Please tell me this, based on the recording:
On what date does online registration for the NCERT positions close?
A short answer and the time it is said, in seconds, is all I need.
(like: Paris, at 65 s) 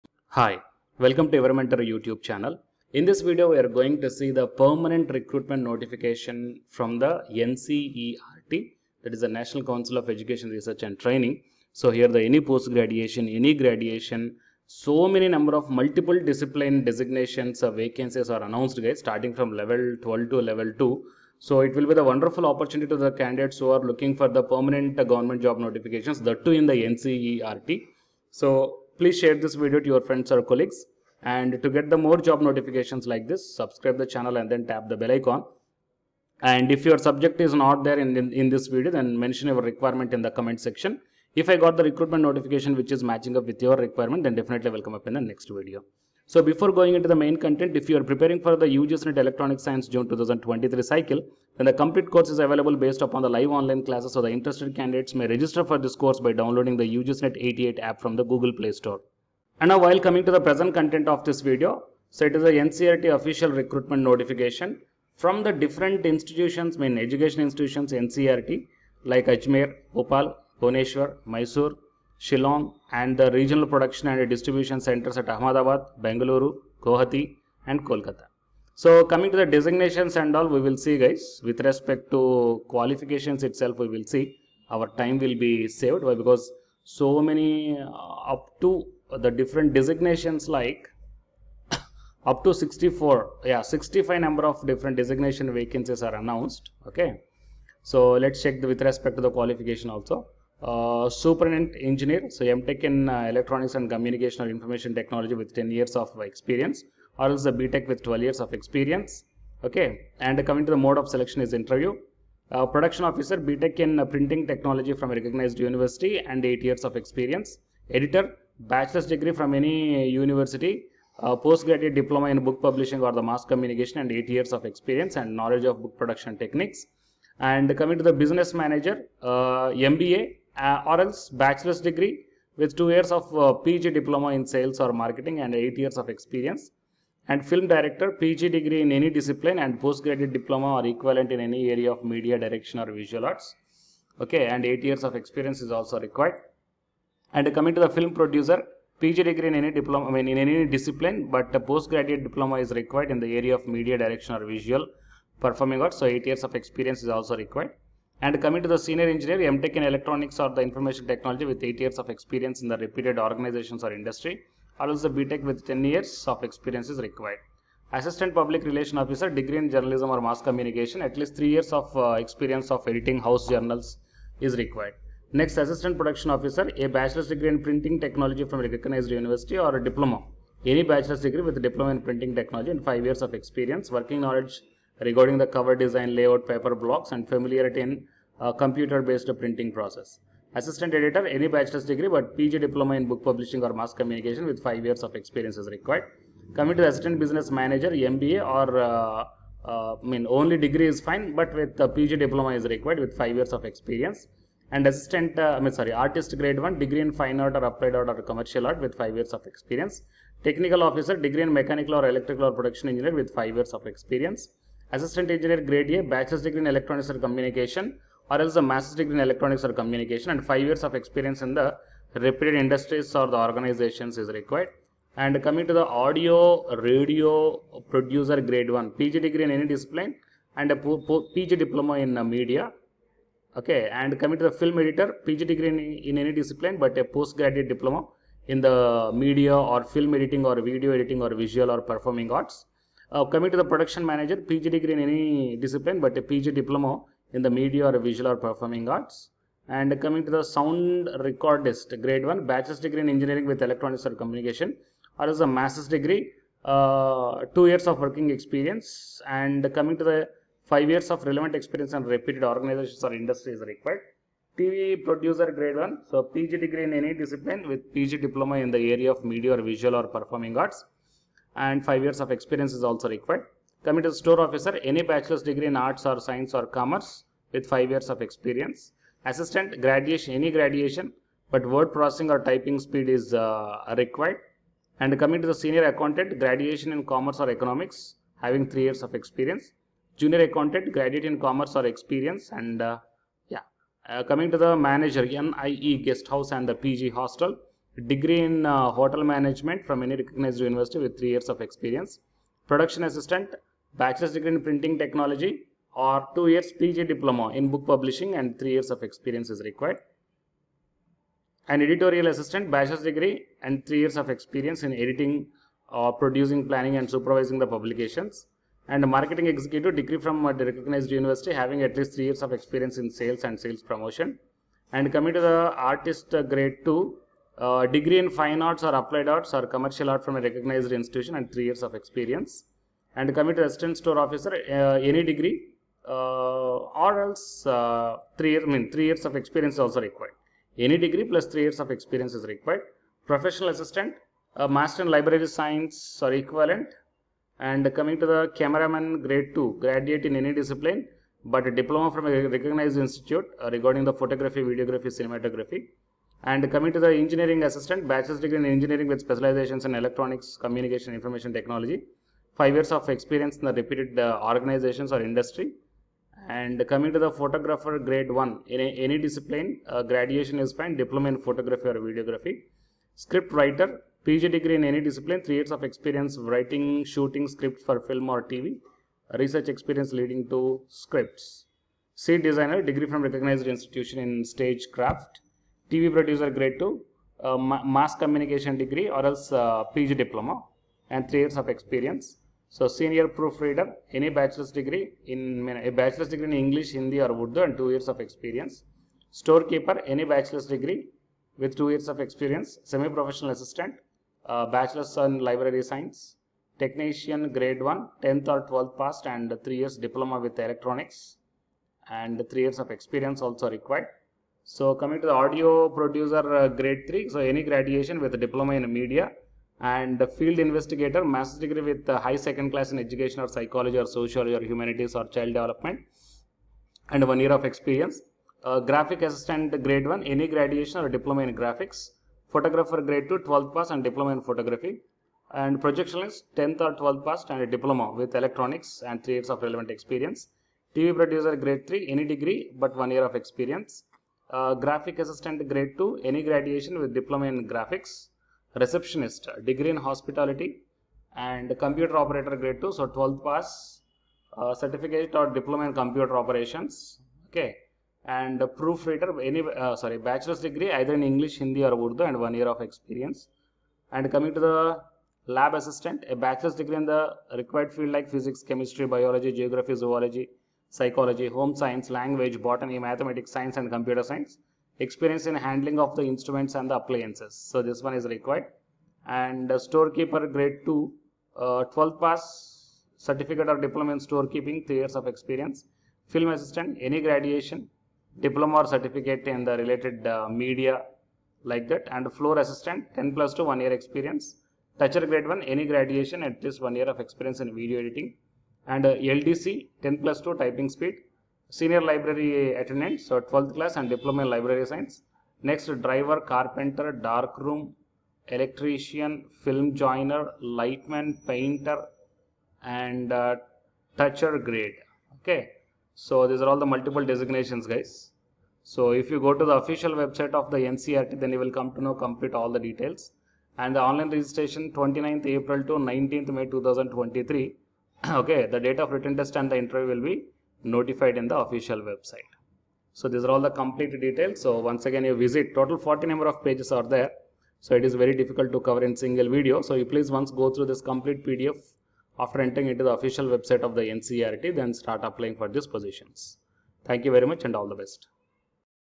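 19 May 2023, at 526 s.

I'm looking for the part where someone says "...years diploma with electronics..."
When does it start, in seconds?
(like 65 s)
409 s.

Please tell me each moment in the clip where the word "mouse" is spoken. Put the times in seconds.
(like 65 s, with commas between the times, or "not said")
not said.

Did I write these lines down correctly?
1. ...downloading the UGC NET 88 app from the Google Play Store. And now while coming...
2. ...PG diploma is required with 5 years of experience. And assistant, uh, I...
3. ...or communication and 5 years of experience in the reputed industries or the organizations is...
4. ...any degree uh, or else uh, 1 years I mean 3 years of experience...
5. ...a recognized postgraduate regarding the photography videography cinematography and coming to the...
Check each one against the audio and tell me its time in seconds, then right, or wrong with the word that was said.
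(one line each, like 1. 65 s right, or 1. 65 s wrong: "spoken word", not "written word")
1. 56 s right
2. 201 s right
3. 219 s right
4. 335 s wrong: "3", not "1"
5. 352 s wrong: "institute", not "postgraduate".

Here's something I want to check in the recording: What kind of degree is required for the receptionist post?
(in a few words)
Hospitality.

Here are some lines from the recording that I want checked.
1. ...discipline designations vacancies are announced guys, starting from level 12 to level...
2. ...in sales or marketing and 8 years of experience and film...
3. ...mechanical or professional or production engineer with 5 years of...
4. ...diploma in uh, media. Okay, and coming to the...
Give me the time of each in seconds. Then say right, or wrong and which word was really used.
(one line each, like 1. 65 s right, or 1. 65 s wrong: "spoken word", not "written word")
1. 16 s right
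2. 134 s right
3. 211 s wrong: "electrical", not "professional"
4. 231 s right.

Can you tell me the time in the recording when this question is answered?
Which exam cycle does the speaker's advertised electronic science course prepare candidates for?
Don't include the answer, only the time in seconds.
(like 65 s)
48 s.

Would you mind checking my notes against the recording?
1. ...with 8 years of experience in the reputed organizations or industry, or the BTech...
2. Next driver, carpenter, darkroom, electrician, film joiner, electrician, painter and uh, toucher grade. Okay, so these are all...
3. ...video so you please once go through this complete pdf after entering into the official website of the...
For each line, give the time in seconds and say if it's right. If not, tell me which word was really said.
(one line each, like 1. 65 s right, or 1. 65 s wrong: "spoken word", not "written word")
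1. 161 s right
2. 505 s wrong: "lightman", not "electrician"
3. 539 s right.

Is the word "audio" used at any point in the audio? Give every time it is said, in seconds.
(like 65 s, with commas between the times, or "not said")
225 s, 415 s.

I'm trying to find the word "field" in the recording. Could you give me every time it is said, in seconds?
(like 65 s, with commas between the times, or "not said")
420 s, 467 s.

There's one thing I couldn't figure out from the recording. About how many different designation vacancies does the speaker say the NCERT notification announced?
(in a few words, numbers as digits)
65.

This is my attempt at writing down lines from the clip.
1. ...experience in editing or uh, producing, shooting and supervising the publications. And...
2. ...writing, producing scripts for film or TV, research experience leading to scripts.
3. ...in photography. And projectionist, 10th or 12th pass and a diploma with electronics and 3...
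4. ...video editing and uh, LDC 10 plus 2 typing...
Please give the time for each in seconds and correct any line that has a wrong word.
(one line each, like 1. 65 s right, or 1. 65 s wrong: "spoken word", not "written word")
1. 314 s wrong: "planning", not "shooting"
2. 376 s wrong: "shooting", not "producing"
3. 434 s right
4. 497 s right.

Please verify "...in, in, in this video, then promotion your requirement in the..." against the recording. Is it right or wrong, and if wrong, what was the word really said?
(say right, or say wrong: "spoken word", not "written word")
wrong: "mention", not "promotion".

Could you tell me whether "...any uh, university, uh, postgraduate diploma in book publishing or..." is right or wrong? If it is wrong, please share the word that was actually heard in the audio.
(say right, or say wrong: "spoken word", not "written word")
right.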